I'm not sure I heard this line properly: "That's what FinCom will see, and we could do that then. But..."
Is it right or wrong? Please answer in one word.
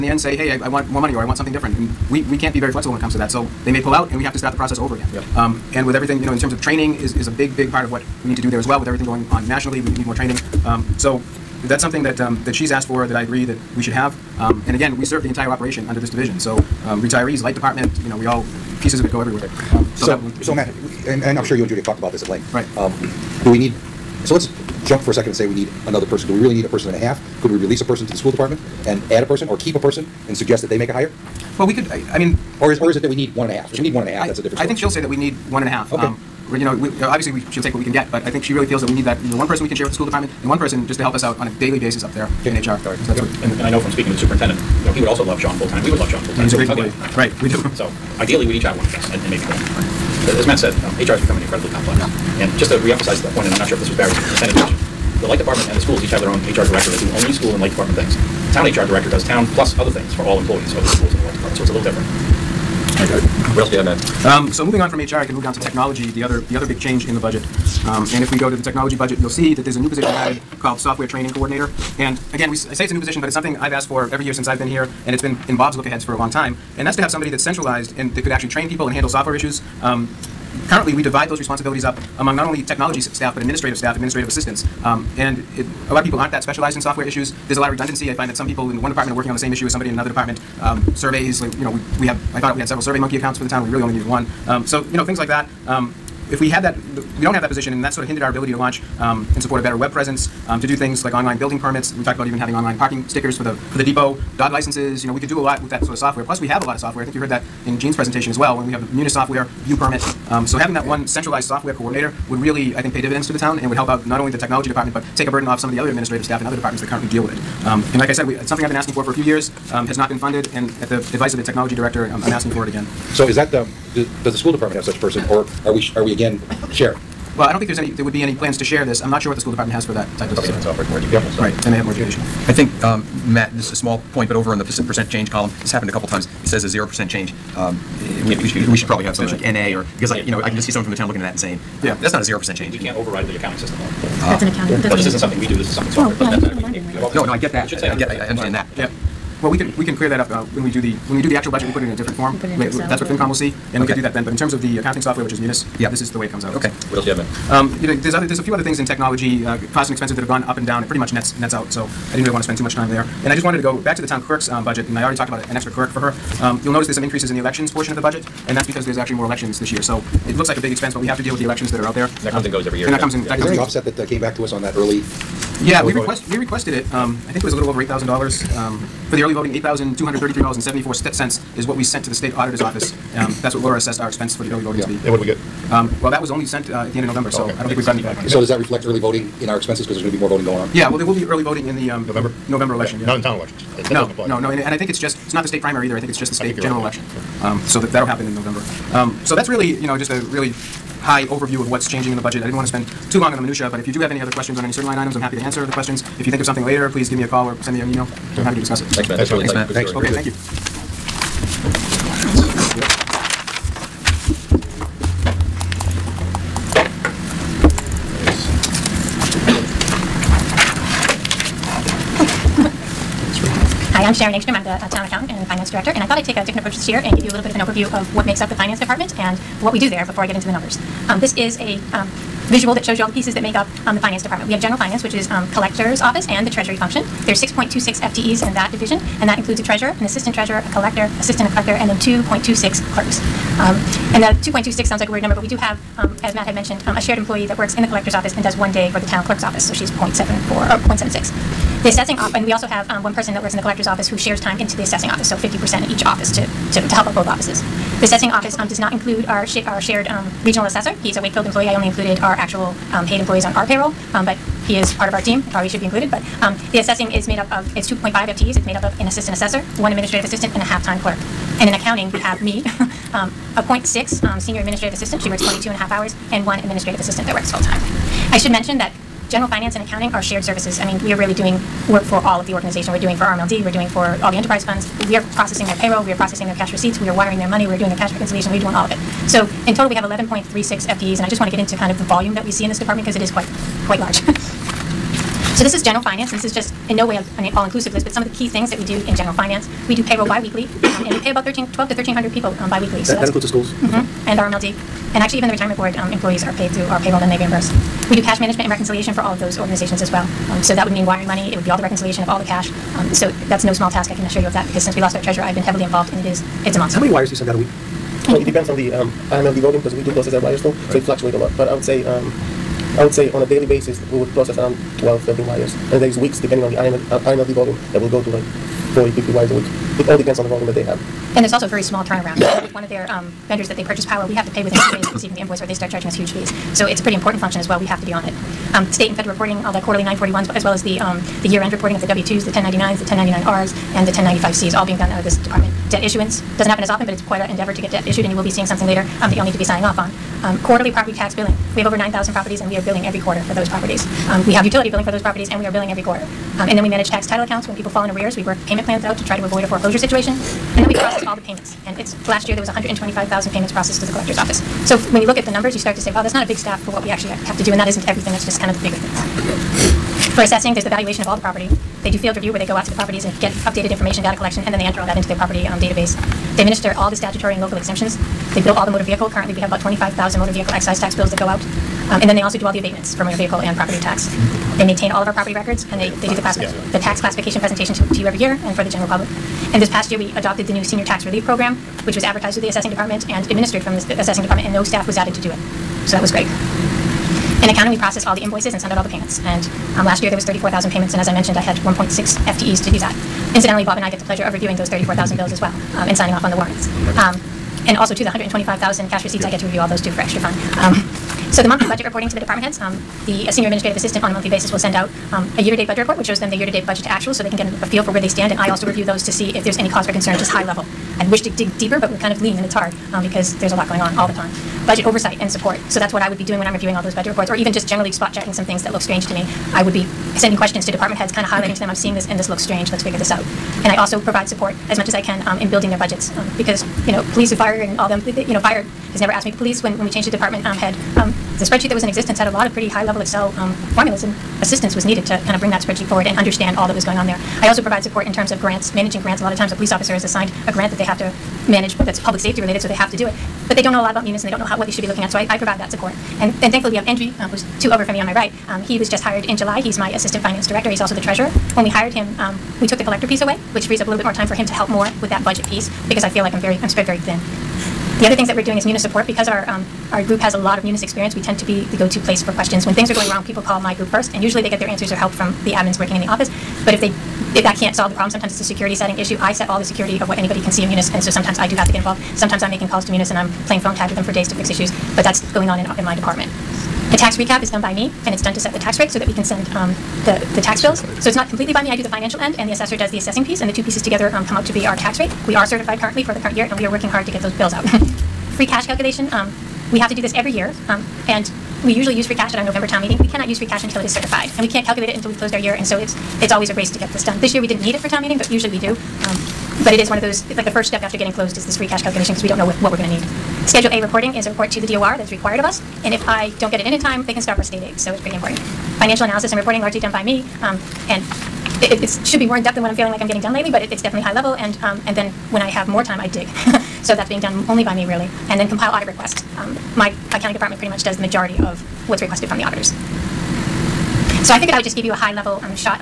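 right.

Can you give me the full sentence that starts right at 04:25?
It probably should be included, but um, the assessing is made up of, it's 2.5 FTEs.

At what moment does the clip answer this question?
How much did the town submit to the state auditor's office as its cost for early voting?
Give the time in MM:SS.
02:59.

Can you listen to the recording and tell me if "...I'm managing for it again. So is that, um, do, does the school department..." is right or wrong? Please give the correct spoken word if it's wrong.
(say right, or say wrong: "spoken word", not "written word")
wrong: "asking", not "managing".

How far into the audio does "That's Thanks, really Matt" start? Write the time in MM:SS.
03:29.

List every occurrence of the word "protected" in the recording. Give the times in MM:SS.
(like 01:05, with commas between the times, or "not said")
not said.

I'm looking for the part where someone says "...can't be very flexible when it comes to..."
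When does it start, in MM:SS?
00:02.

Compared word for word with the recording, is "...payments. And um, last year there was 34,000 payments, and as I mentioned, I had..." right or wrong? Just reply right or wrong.
right.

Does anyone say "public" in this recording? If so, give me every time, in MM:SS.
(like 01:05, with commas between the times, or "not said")
06:29, 07:32.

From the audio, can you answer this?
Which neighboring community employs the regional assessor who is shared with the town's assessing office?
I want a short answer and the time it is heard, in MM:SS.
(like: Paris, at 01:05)
Wakefield, at 04:21.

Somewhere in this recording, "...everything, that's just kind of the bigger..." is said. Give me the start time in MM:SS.
06:08.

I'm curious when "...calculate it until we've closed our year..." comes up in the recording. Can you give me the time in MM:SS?
08:24.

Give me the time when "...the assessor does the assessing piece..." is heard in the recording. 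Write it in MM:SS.
08:12.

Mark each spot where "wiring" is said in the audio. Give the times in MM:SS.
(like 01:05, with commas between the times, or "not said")
04:47, 05:11.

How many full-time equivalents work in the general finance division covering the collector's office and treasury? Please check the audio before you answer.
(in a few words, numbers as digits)
6.26.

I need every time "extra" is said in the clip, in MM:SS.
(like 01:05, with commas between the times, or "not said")
02:45, 06:50.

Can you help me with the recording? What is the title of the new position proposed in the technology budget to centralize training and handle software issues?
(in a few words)
software training coordinator.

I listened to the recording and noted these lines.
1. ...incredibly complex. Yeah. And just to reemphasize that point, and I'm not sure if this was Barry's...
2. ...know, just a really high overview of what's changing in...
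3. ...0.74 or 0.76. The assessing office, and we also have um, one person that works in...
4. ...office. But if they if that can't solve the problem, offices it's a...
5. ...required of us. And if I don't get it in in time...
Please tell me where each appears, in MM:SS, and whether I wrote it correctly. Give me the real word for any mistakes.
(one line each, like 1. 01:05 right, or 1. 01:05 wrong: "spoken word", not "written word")
1. 00:51 right
2. 03:19 right
3. 04:09 right
4. 07:56 wrong: "sometimes", not "offices"
5. 08:35 right.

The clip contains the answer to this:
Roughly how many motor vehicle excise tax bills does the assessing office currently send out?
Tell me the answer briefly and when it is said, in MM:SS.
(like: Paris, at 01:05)
25,000, at 06:19.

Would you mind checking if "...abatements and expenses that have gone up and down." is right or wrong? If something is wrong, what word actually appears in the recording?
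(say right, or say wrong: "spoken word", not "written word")
wrong: "costs", not "abatements".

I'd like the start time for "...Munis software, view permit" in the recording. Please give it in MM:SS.
01:48.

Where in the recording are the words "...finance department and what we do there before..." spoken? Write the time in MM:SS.
03:48.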